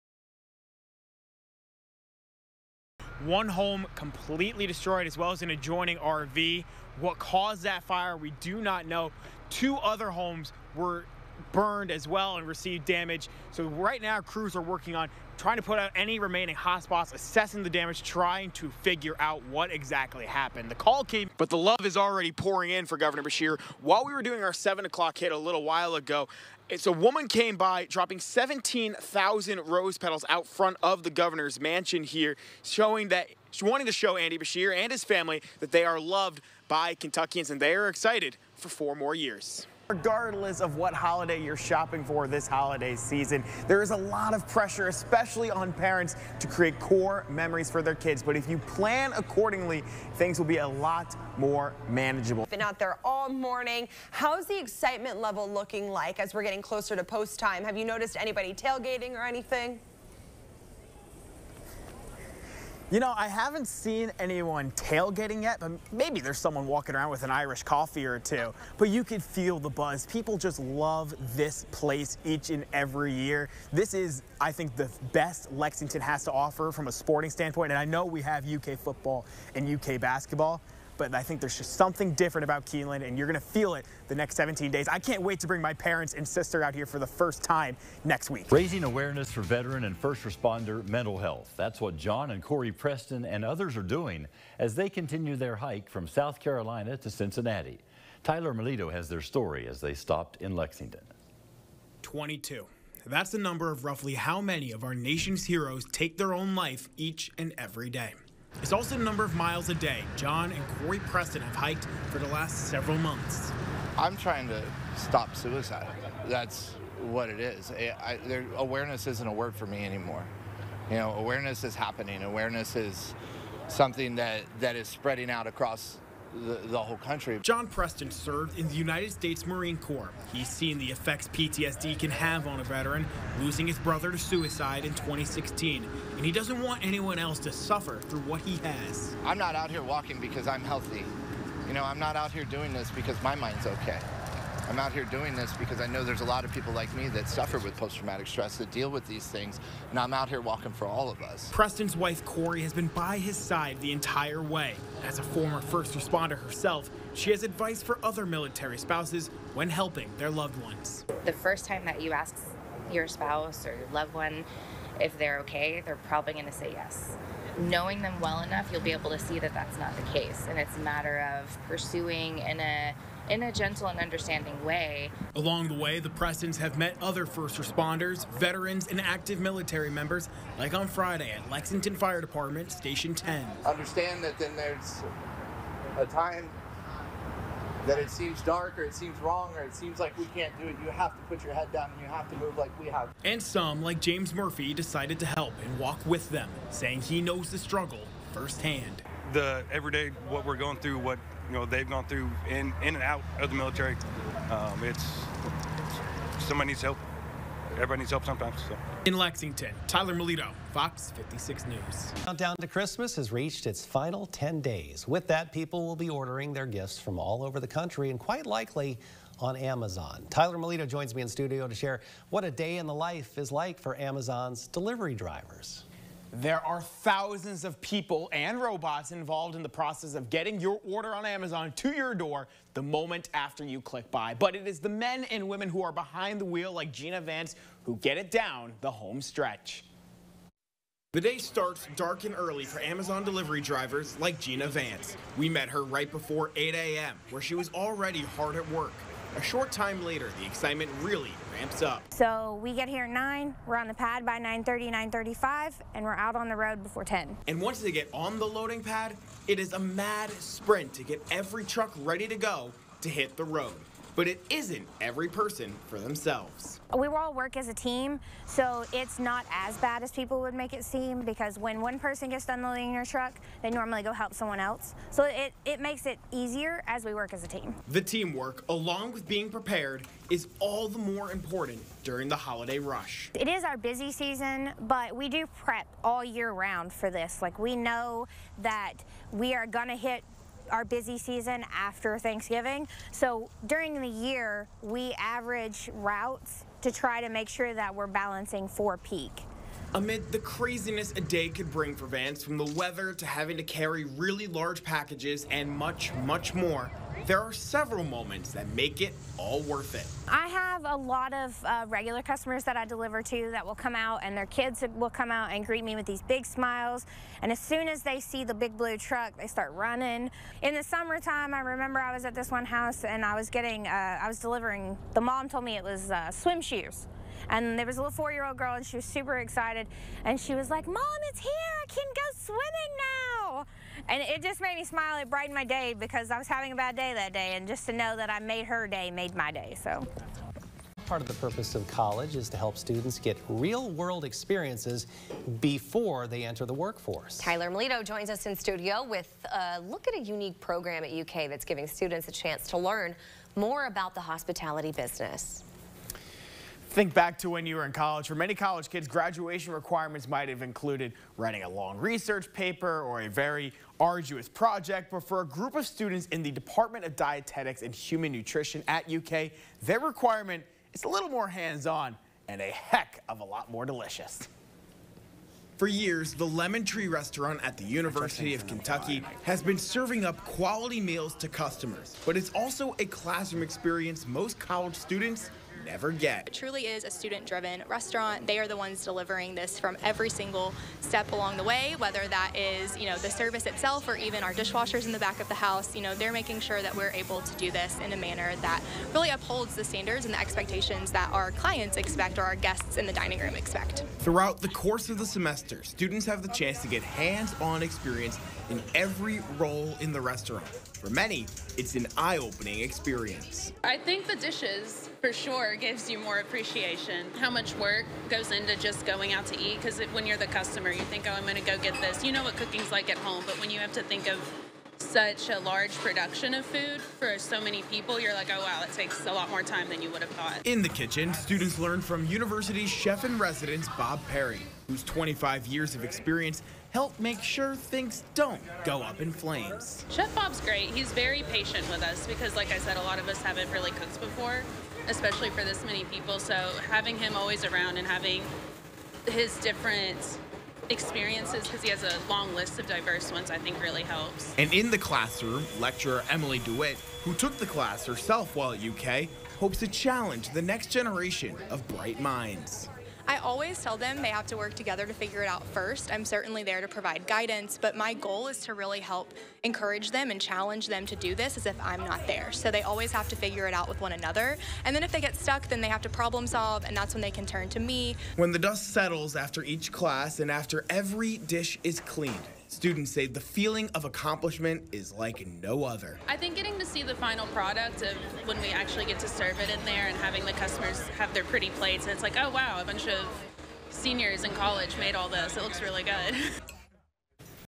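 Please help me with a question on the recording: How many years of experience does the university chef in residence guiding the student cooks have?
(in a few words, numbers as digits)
25.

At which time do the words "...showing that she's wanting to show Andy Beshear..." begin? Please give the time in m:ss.
0:32.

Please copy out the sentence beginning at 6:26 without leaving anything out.
It truly is a student driven restaurant.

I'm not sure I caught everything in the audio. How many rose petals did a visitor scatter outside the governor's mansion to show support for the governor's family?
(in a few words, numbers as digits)
17,000.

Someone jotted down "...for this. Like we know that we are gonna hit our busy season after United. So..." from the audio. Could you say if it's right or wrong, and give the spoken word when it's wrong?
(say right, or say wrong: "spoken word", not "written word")
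wrong: "Thanksgiving", not "United".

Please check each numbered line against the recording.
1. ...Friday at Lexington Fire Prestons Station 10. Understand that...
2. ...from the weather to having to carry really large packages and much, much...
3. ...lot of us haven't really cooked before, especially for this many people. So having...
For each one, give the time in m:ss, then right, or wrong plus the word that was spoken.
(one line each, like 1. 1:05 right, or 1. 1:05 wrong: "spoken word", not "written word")
1. 3:00 wrong: "Department", not "Prestons"
2. 5:02 right
3. 7:23 right.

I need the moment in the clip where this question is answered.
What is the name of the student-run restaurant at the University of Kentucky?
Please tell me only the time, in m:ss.
6:16.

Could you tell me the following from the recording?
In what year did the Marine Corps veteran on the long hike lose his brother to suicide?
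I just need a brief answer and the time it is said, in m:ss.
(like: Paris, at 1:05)
2016, at 2:14.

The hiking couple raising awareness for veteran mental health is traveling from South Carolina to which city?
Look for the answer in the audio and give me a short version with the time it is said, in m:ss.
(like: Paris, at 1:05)
Cincinnati, at 1:37.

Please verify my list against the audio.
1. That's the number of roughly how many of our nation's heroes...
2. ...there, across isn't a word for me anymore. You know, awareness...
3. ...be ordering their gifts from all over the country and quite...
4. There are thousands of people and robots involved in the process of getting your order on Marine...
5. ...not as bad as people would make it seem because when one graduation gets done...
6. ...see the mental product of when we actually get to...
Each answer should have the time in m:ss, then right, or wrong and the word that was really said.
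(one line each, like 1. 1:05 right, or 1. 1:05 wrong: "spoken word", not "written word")
1. 1:43 right
2. 1:58 wrong: "awareness", not "across"
3. 3:35 right
4. 3:46 wrong: "Amazon", not "Marine"
5. 4:29 wrong: "person", not "graduation"
6. 8:06 wrong: "final", not "mental".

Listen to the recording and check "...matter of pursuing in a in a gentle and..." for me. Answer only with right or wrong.
right.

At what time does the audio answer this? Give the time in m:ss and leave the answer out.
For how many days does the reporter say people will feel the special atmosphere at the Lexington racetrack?
1:24.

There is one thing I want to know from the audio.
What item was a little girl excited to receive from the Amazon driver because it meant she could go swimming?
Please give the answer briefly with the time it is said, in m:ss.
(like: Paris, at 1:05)
Swim shoes, at 5:26.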